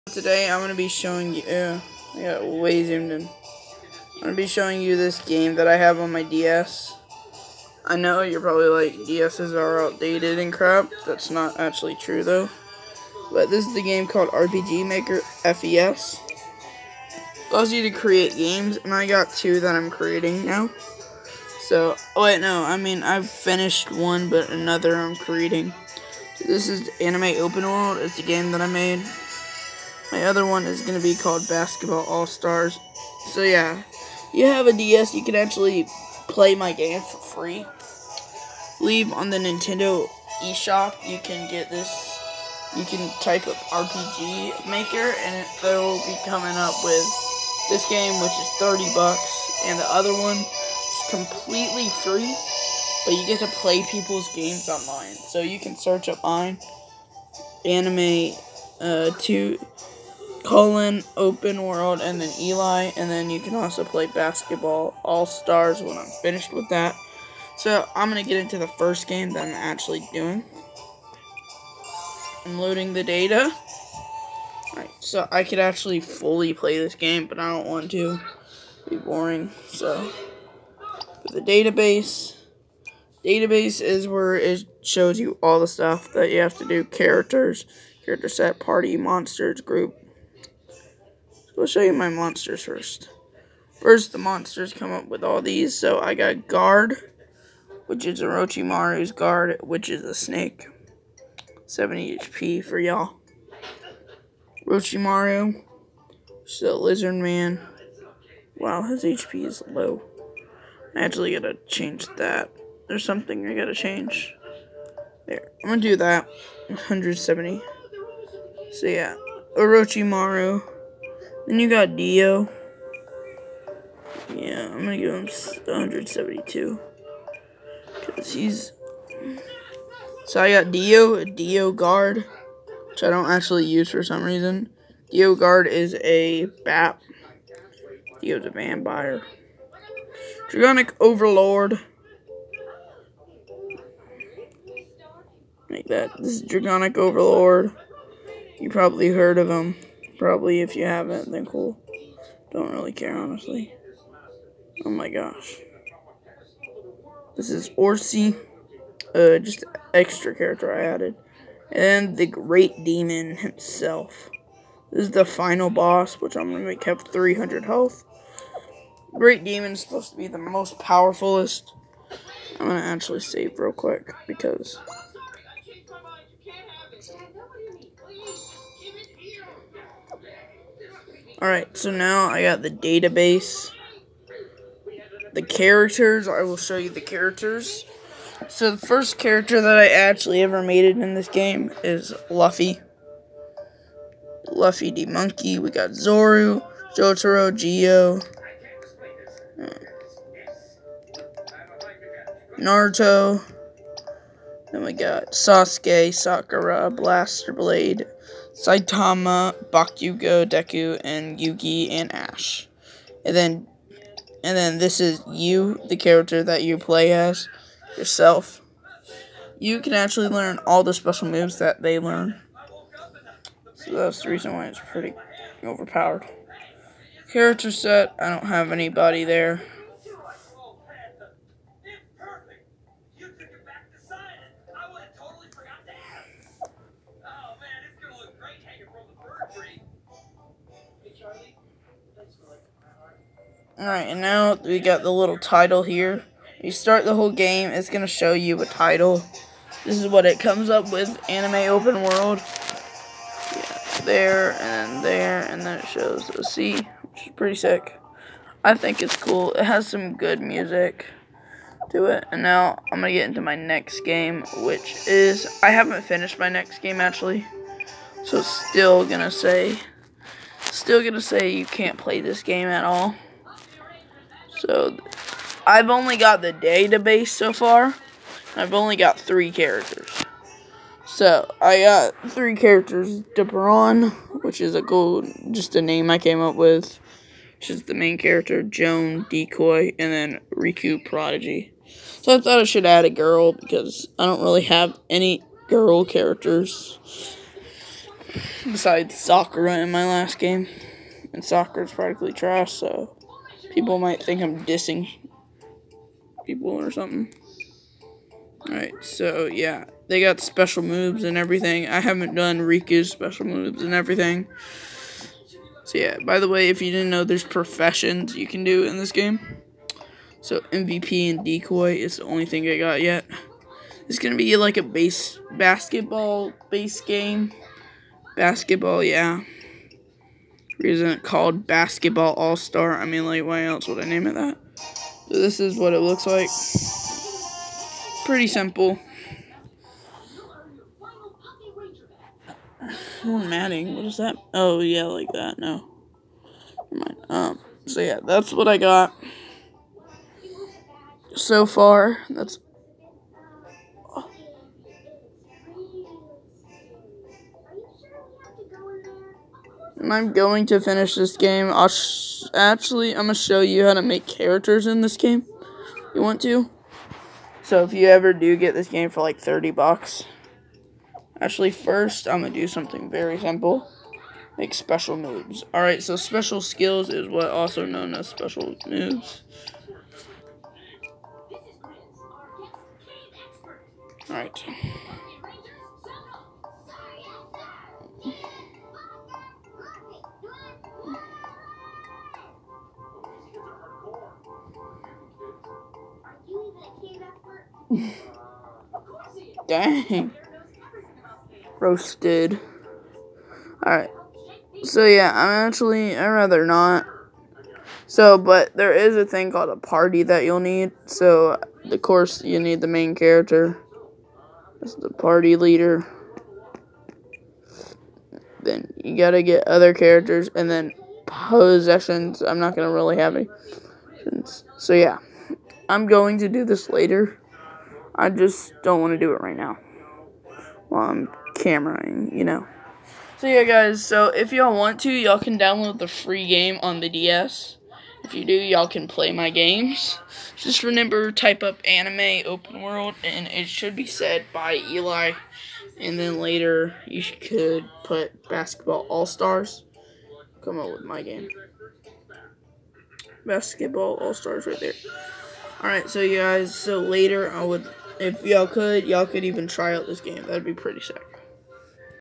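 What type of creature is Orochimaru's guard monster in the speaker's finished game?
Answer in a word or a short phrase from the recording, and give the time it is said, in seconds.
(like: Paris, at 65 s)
A snake, at 100 s.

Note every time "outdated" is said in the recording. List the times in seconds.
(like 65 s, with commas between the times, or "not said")
9 s.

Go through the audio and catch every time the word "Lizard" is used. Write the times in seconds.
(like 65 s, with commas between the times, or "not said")
106 s.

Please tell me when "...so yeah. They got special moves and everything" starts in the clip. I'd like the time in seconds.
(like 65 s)
309 s.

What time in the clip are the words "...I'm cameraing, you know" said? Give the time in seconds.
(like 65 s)
431 s.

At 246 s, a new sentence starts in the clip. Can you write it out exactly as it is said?
You start the whole game, it's going to show you a title.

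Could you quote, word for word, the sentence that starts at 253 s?
Yeah, there, and then there, and then it shows a C, sea, which is pretty sick.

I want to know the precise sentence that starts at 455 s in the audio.
Alright, so you guys, so later I would if y'all could, y'all could even try out this game.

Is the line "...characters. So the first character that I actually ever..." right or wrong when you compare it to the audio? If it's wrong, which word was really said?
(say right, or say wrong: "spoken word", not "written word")
right.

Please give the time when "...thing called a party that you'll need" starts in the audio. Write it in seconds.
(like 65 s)
409 s.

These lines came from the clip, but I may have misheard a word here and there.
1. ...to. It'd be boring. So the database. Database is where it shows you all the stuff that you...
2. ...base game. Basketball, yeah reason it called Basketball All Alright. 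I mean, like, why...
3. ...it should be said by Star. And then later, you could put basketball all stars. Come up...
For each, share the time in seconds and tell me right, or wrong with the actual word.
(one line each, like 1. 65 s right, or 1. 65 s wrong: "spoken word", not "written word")
1. 77 s right
2. 326 s wrong: "Star", not "Alright"
3. 443 s wrong: "Eli", not "Star".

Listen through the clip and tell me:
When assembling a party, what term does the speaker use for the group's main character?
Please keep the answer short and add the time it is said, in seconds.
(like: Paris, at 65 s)
party leader, at 415 s.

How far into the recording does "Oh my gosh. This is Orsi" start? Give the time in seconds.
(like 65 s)
154 s.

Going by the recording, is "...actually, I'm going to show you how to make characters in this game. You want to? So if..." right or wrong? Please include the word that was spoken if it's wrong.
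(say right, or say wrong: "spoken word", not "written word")
right.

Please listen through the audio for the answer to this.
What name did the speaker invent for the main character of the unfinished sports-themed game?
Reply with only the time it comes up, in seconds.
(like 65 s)
283 s.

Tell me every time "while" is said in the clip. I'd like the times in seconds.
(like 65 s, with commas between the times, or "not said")
430 s.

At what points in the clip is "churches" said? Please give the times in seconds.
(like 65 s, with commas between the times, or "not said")
not said.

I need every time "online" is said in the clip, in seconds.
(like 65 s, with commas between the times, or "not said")
54 s.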